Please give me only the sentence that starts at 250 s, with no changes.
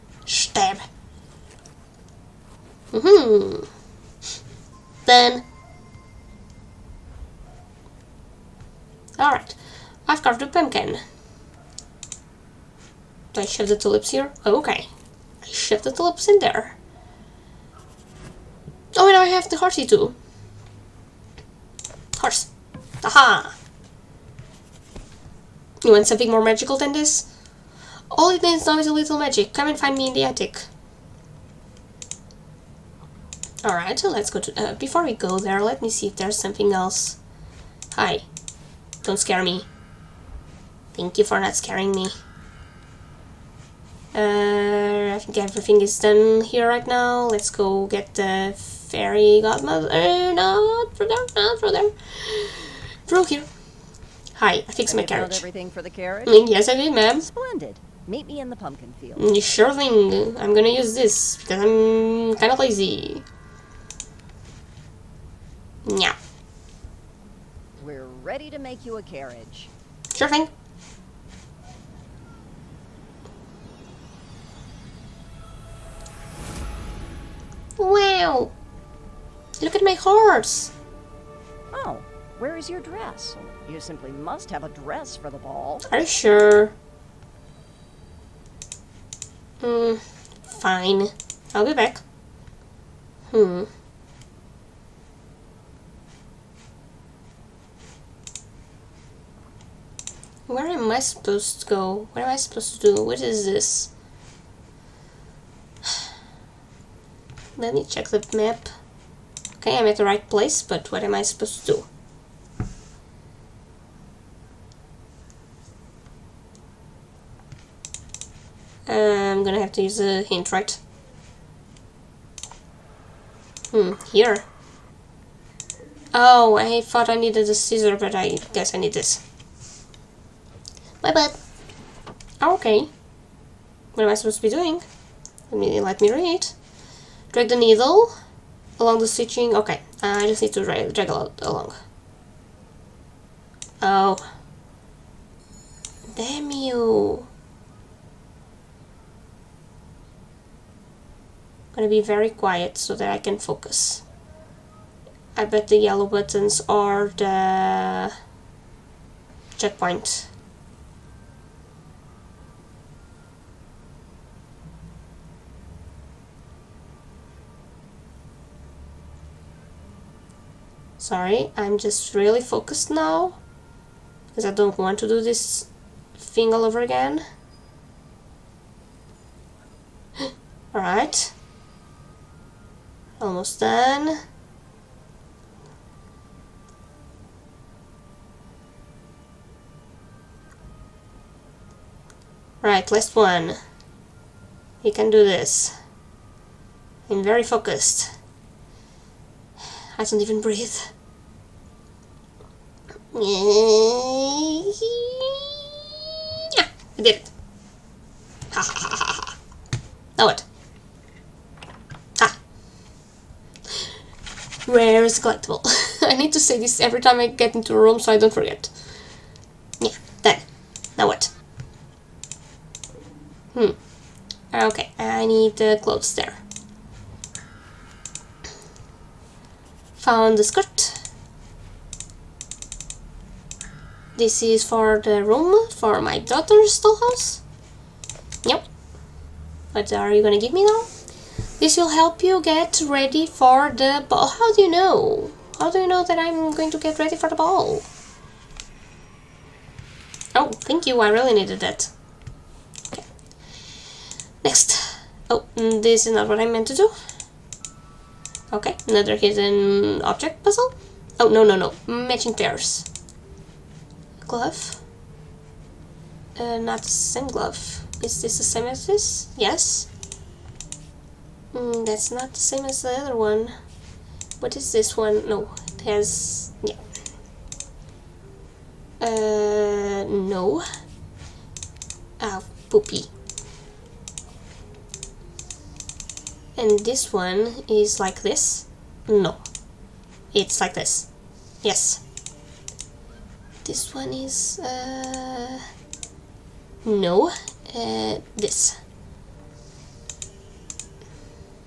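Oh, thank you, I really needed that.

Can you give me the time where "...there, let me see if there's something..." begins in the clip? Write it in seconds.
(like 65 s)
35 s.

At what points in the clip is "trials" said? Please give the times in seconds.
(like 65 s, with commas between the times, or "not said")
not said.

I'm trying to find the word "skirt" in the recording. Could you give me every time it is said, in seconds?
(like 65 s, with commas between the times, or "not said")
230 s.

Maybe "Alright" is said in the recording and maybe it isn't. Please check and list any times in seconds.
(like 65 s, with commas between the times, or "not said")
9 s, 33 s, 180 s.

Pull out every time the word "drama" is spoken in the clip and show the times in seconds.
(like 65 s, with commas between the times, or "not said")
not said.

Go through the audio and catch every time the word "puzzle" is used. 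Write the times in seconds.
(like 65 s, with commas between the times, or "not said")
260 s.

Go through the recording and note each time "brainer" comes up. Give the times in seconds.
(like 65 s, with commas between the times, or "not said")
not said.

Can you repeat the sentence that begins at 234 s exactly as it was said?
This is for the room, for my daughter's dollhouse.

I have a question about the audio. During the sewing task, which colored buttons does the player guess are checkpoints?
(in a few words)
yellow.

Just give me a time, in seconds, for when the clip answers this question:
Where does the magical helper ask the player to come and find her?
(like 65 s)
30 s.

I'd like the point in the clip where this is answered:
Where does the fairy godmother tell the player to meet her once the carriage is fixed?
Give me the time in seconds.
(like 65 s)
58 s.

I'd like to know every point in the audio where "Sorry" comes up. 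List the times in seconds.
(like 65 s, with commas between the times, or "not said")
170 s.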